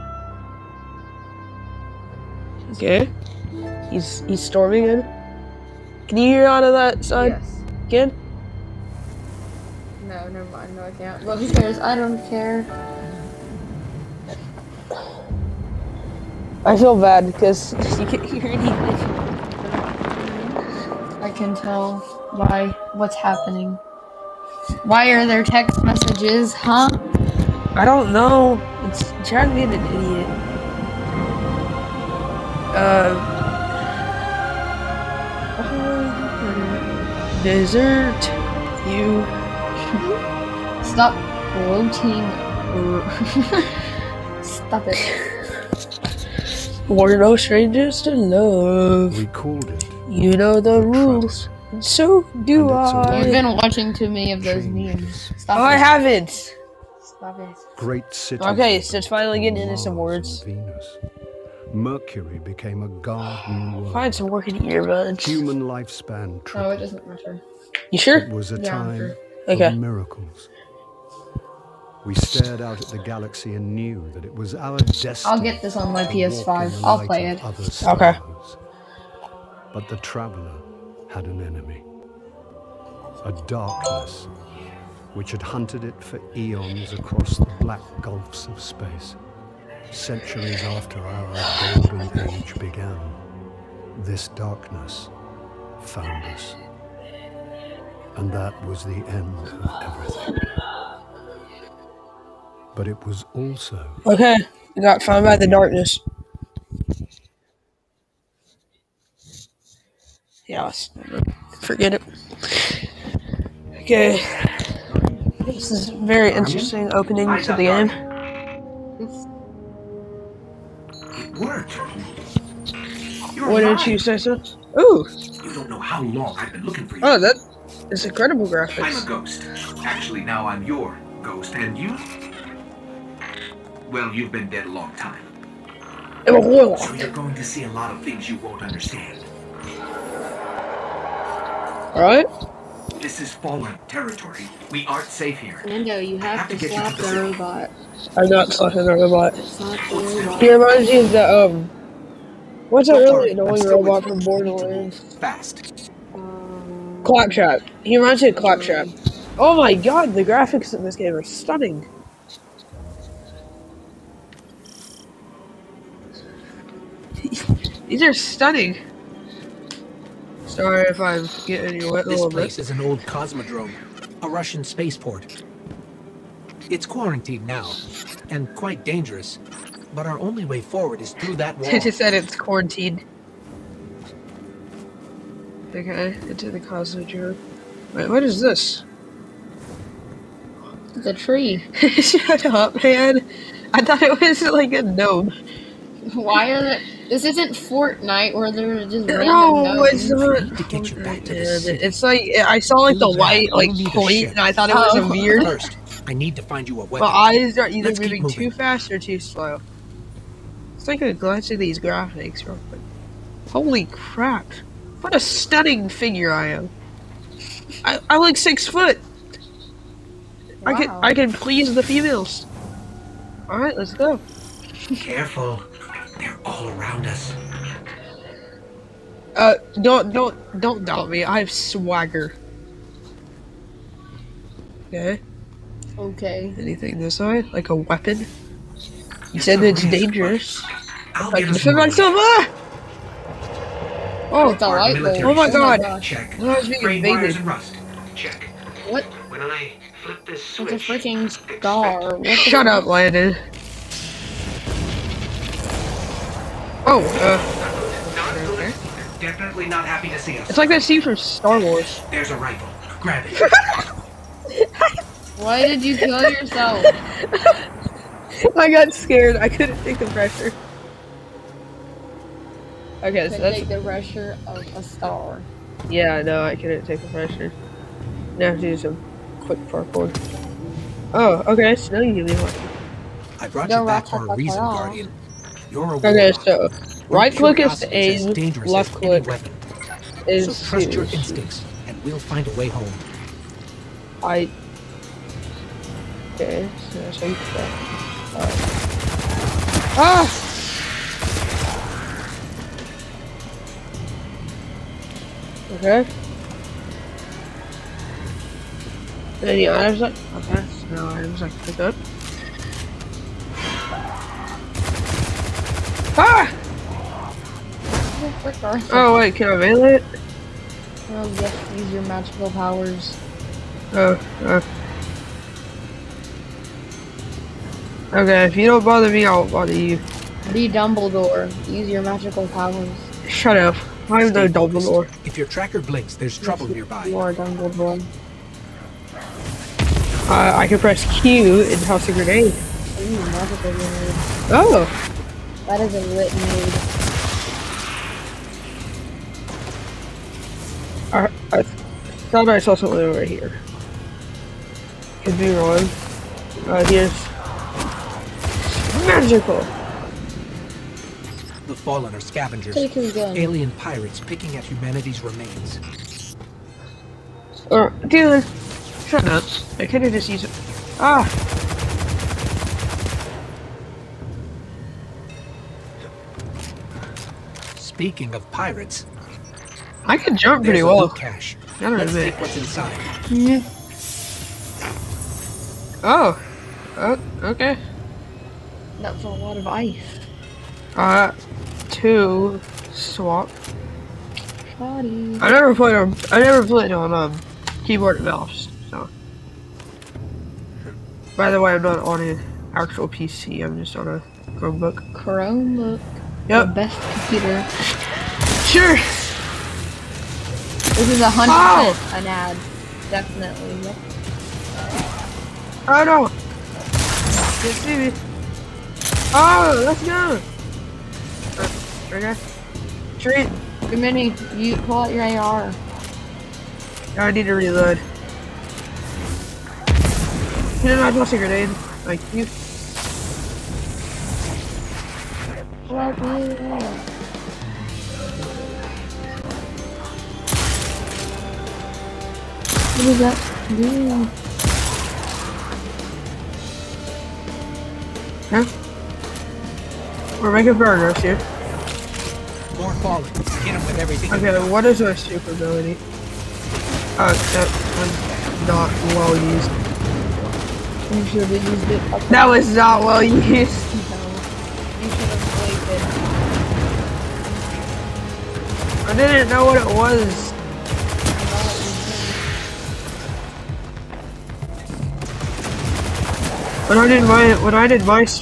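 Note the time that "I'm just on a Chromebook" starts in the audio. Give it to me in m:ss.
6:43.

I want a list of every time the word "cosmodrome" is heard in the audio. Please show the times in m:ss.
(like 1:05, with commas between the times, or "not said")
2:52, 3:06.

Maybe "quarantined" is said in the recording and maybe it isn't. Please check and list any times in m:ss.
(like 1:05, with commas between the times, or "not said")
2:56, 3:02.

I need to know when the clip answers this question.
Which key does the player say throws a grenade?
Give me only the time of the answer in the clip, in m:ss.
5:41.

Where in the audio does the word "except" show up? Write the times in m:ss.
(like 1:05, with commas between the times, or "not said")
7:37.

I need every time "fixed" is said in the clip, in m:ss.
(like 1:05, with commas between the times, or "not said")
not said.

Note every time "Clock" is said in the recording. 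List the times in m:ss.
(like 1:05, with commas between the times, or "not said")
2:36.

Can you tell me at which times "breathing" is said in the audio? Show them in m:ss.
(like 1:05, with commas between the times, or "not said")
not said.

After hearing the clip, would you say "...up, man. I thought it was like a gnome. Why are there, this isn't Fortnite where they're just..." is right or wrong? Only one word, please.
right.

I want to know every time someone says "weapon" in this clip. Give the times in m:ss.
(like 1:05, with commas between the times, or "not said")
3:26, 3:57.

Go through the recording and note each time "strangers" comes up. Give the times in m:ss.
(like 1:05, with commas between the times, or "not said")
0:47.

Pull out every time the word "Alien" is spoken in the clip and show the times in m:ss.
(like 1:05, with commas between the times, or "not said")
6:02.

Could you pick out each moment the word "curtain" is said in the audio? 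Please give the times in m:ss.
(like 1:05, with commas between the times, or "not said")
not said.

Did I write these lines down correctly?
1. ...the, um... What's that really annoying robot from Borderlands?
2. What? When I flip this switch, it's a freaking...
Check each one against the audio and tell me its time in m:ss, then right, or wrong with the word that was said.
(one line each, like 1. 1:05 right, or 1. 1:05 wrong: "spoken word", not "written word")
1. 2:31 right
2. 4:08 right.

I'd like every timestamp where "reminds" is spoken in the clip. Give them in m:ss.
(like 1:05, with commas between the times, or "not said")
2:30, 2:37.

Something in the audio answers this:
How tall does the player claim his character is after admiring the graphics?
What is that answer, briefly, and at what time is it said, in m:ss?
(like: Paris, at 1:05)
six foot, at 3:38.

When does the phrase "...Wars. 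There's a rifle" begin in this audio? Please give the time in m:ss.
4:21.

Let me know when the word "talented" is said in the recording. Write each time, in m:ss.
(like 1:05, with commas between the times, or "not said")
not said.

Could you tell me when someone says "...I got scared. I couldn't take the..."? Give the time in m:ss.
4:28.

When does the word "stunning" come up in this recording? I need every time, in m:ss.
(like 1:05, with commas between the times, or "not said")
2:41, 2:48, 3:35.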